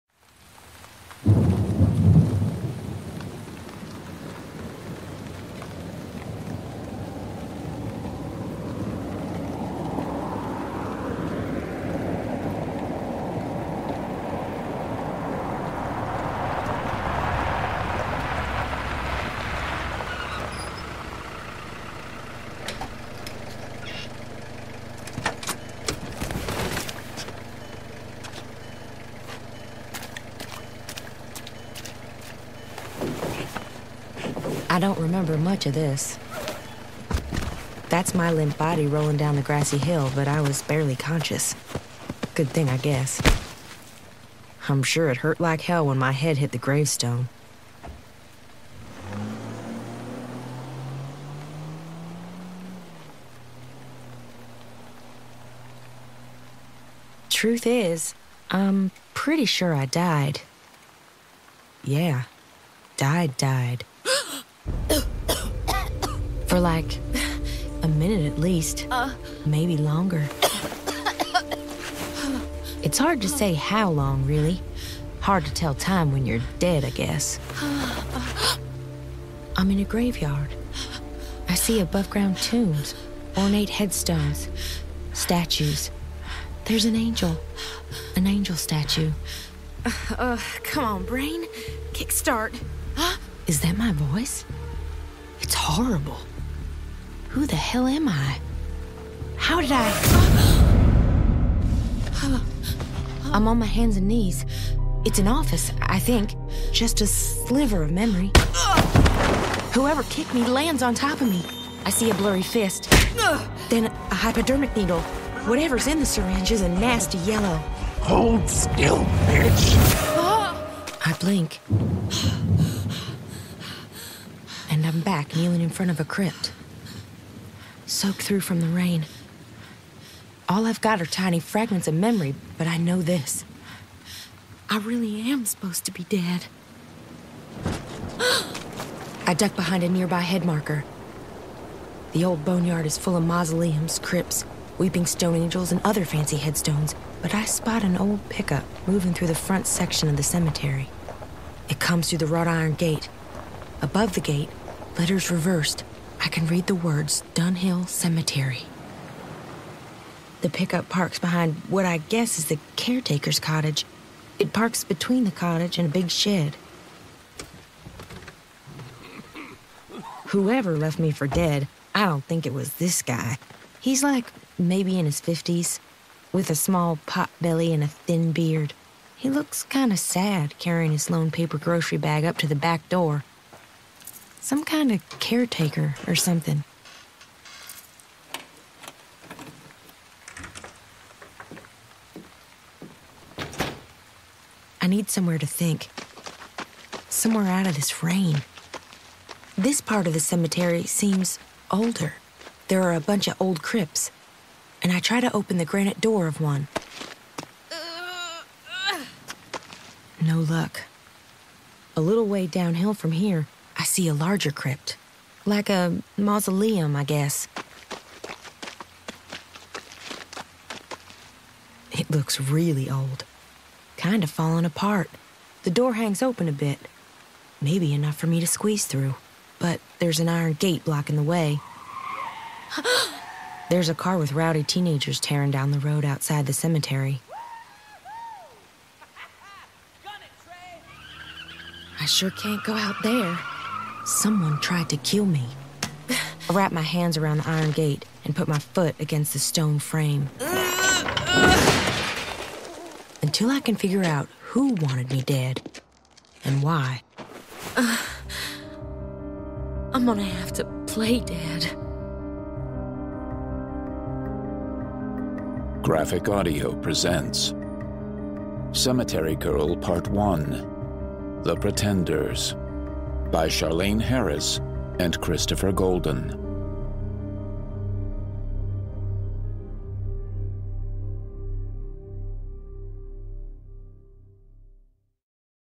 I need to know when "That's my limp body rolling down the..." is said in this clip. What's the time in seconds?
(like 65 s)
37 s.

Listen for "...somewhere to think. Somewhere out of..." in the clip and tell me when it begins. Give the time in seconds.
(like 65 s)
195 s.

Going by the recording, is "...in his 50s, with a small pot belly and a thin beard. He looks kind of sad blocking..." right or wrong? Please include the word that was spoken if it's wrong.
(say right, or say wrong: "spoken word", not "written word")
wrong: "carrying", not "blocking".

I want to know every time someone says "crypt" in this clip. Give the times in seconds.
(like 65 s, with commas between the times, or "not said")
126 s, 143 s, 203 s, 214 s.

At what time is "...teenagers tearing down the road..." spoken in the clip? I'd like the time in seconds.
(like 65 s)
234 s.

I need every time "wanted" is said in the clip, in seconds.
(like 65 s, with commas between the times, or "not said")
254 s.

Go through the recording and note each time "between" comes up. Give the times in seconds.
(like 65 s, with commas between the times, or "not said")
164 s.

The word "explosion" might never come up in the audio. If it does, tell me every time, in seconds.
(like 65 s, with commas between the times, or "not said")
not said.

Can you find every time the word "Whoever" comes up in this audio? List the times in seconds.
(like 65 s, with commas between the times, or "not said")
109 s, 170 s.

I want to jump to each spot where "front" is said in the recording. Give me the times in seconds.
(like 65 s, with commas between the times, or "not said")
125 s, 149 s.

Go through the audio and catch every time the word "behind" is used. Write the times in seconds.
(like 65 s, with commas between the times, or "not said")
139 s, 161 s.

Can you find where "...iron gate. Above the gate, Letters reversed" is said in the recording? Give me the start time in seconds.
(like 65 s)
152 s.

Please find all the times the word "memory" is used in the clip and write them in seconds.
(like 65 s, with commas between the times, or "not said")
107 s, 131 s.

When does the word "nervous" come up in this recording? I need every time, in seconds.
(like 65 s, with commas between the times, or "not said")
not said.